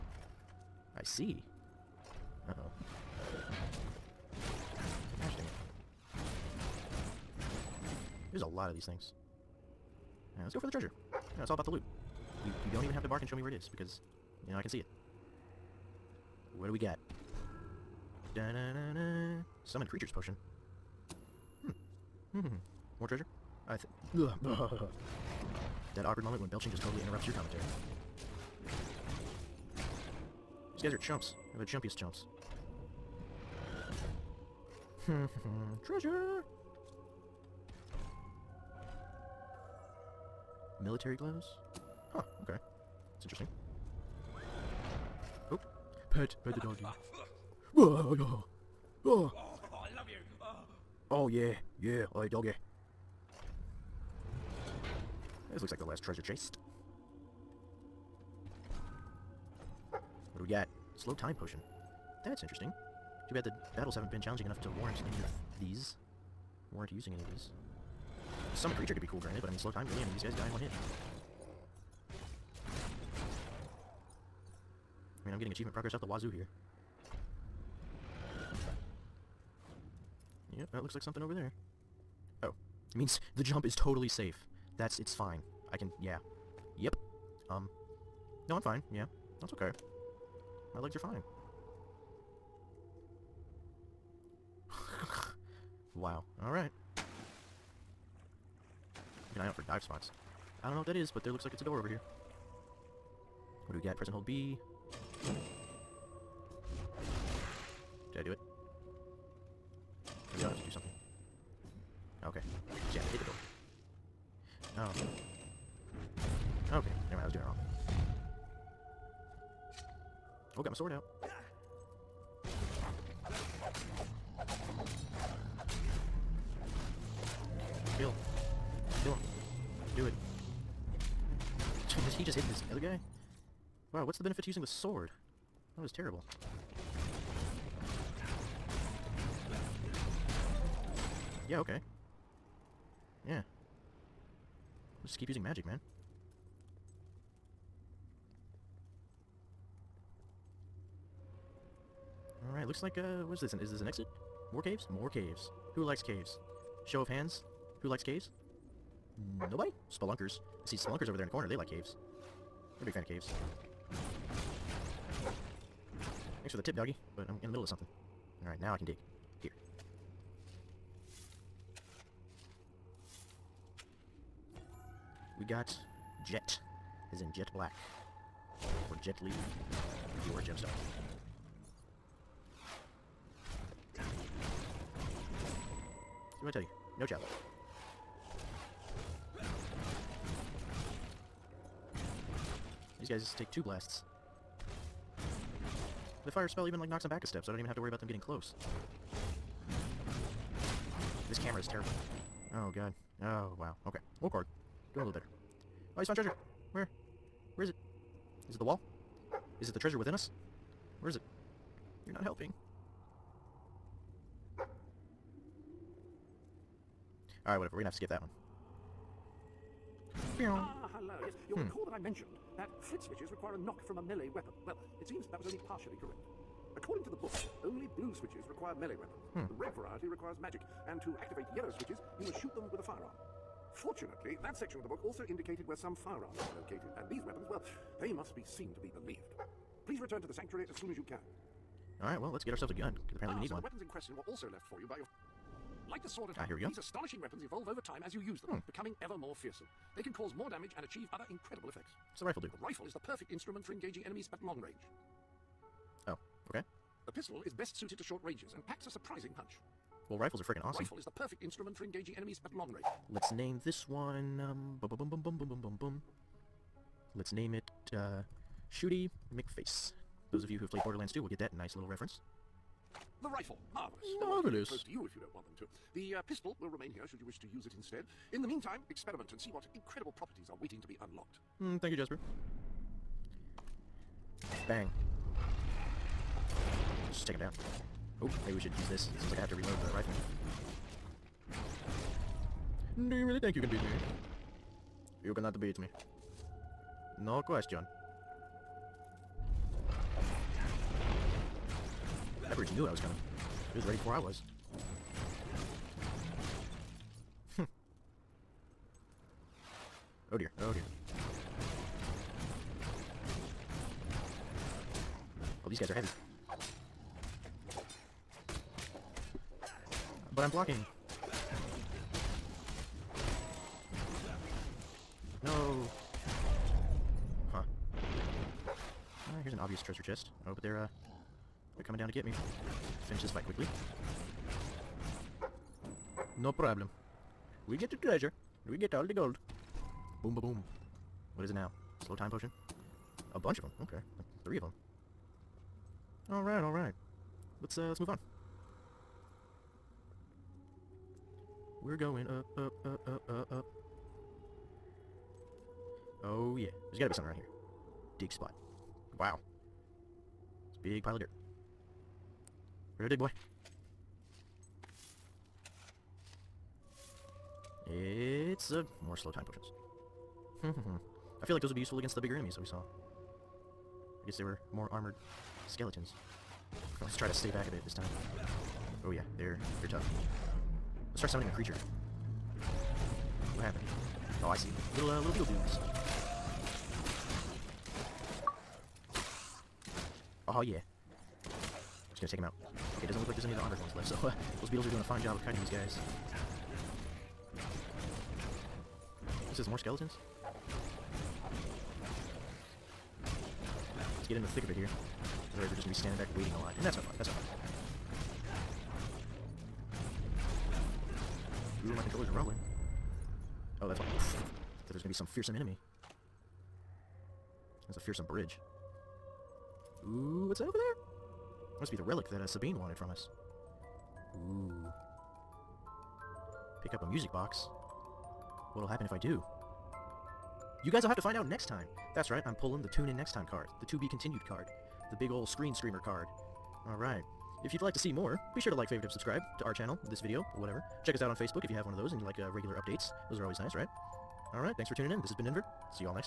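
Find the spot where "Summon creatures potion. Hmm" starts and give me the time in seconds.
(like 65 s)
19 s.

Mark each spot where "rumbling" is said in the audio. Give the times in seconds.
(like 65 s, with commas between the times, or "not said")
412 s.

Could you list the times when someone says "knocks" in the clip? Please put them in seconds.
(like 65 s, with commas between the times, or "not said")
196 s, 223 s.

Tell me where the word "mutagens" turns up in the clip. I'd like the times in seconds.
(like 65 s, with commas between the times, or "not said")
not said.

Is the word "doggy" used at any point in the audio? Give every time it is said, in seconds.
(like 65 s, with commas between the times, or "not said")
46 s, 52 s, 166 s.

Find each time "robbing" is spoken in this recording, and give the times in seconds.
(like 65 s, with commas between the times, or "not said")
not said.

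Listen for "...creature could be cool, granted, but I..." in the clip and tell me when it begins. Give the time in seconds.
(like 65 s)
68 s.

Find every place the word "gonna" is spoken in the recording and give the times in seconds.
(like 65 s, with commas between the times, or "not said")
217 s, 392 s.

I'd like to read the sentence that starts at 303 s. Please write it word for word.
He was ready before I was.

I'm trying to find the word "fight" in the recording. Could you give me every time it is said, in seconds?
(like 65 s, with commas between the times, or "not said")
333 s.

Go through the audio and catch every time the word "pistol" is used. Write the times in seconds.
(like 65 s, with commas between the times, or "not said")
257 s, 276 s.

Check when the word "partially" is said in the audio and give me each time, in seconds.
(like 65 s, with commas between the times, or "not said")
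225 s.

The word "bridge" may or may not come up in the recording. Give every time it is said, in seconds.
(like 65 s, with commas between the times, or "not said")
418 s.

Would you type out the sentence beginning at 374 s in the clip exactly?
I guess they were more armored skeletons.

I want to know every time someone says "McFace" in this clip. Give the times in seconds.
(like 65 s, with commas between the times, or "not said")
269 s.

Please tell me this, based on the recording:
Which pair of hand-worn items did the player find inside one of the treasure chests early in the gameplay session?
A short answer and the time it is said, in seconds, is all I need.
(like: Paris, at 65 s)
Military gloves, at 40 s.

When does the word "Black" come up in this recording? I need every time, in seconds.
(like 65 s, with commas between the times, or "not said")
177 s.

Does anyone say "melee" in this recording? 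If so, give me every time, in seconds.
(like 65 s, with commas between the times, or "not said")
224 s, 228 s.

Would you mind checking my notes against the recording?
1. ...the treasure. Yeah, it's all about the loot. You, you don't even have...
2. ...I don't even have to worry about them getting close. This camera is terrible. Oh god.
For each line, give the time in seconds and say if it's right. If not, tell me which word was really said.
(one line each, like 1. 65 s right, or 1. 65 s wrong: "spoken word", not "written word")
1. 10 s right
2. 197 s right.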